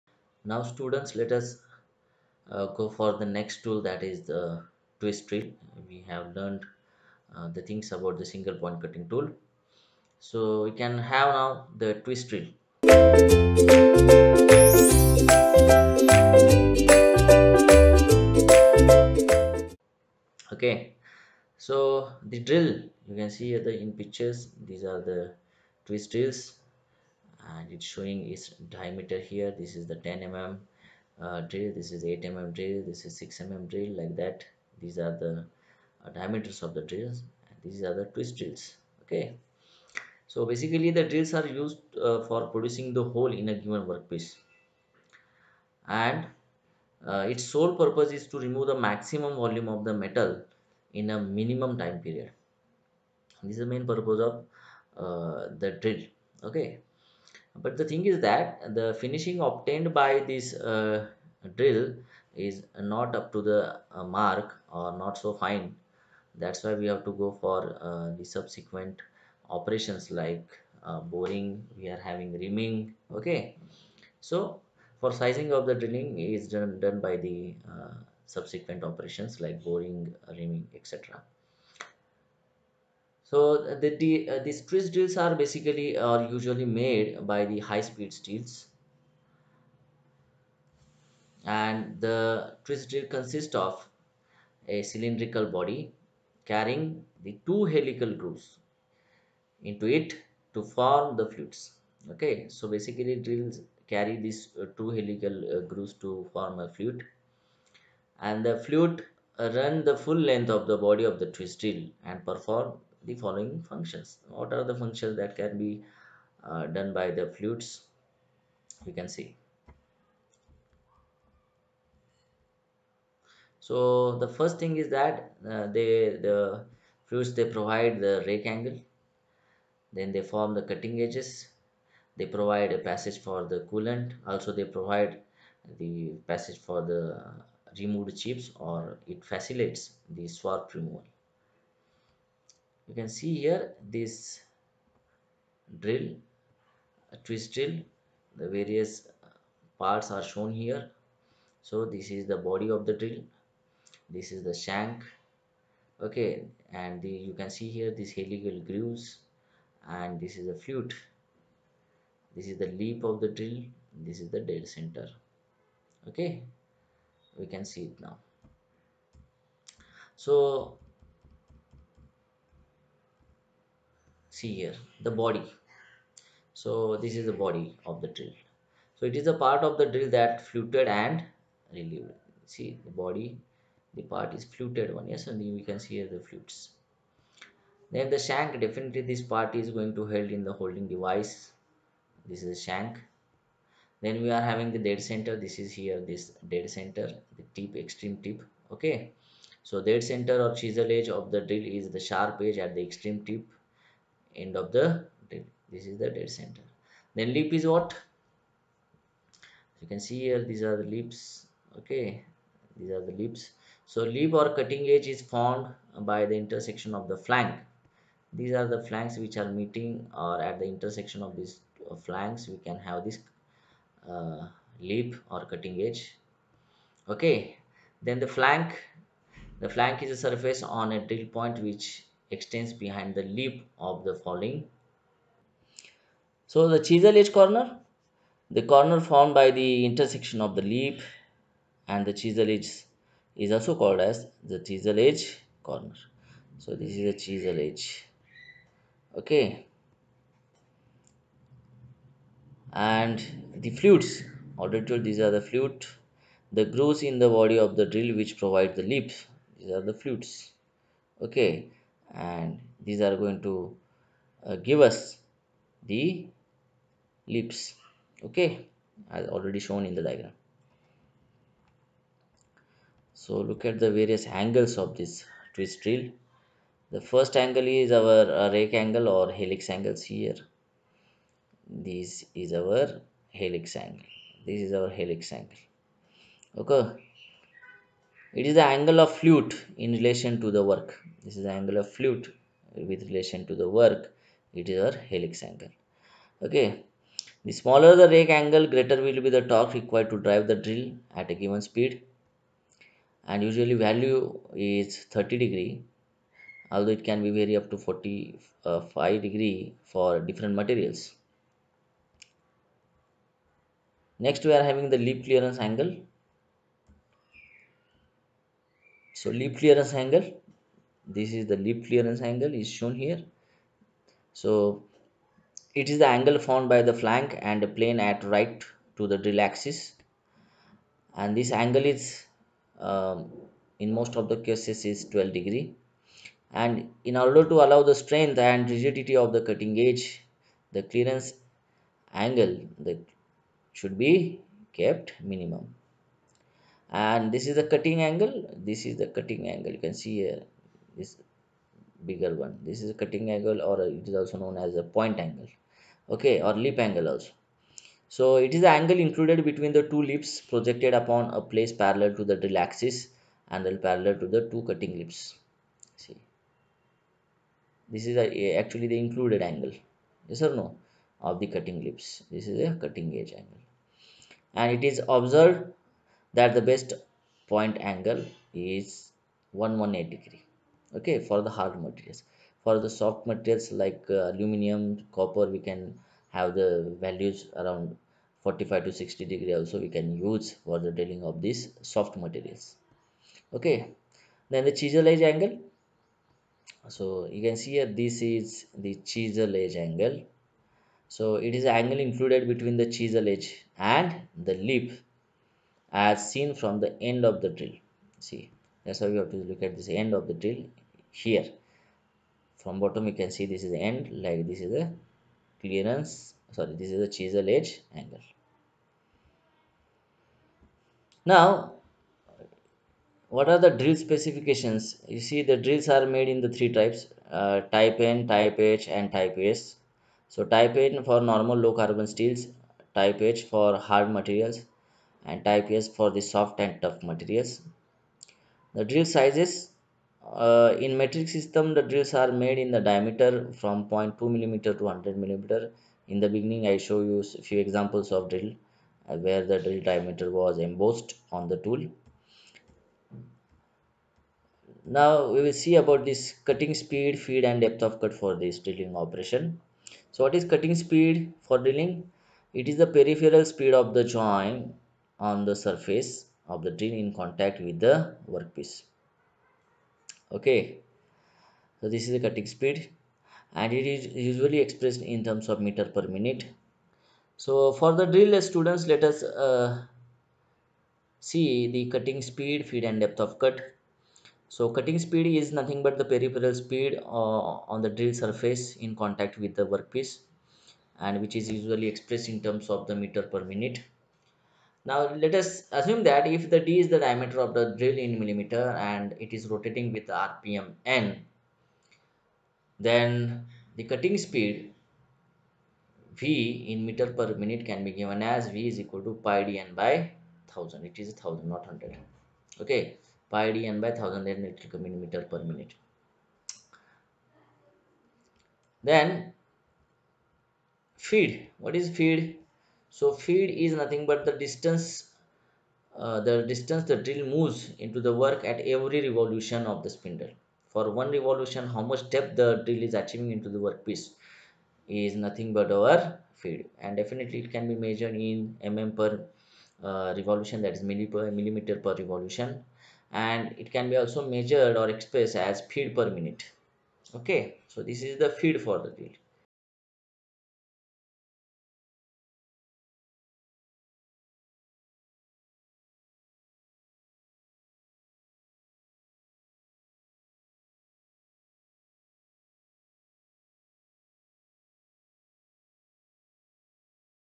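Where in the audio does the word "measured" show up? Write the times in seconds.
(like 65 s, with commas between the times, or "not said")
537 s, 544 s.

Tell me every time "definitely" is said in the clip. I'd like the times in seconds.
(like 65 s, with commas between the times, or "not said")
188 s, 537 s.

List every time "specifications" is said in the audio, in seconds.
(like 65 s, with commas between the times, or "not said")
424 s.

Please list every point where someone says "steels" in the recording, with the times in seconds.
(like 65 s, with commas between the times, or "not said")
88 s, 432 s.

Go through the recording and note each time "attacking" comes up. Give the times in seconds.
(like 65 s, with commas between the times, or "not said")
not said.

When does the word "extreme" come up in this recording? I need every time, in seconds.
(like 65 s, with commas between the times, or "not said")
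197 s, 202 s.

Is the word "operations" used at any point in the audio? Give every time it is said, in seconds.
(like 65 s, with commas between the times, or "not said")
69 s, 78 s, 458 s.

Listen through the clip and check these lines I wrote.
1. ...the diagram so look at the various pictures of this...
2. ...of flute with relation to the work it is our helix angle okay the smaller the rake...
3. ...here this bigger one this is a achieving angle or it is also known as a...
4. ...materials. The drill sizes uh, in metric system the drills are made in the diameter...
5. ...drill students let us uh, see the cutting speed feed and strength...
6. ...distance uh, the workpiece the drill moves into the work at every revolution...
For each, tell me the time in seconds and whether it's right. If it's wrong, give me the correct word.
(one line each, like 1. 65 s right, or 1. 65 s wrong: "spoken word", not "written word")
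1. 269 s wrong: "angles", not "pictures"
2. 291 s right
3. 350 s wrong: "cutting", not "achieving"
4. 437 s right
5. 478 s wrong: "depth", not "strength"
6. 524 s wrong: "distance", not "workpiece".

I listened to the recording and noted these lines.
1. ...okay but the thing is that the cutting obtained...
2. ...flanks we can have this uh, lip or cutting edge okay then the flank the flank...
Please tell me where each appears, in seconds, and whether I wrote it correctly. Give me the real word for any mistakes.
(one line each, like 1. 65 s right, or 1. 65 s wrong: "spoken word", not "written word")
1. 56 s wrong: "finishing", not "cutting"
2. 221 s right.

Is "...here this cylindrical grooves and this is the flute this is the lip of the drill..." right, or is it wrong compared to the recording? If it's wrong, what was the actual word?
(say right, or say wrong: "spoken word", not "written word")
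wrong: "helical", not "cylindrical".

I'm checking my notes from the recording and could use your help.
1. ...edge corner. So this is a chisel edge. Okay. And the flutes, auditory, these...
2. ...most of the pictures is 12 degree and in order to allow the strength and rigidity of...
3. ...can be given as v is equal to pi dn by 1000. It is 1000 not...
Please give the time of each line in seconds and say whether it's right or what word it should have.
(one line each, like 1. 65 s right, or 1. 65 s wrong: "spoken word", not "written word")
1. 244 s right
2. 333 s wrong: "cases", not "pictures"
3. 507 s right.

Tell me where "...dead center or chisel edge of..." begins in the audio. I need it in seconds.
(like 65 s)
199 s.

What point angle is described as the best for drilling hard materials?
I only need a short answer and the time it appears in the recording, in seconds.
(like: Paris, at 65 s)
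118 degrees, at 379 s.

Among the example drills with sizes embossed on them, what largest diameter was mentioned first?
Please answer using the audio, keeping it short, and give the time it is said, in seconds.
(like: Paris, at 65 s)
10 mm, at 29 s.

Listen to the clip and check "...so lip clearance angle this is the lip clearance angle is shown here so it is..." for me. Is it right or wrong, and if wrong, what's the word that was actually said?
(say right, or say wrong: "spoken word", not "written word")
right.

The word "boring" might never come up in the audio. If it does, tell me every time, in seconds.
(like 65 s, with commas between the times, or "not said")
71 s, 79 s.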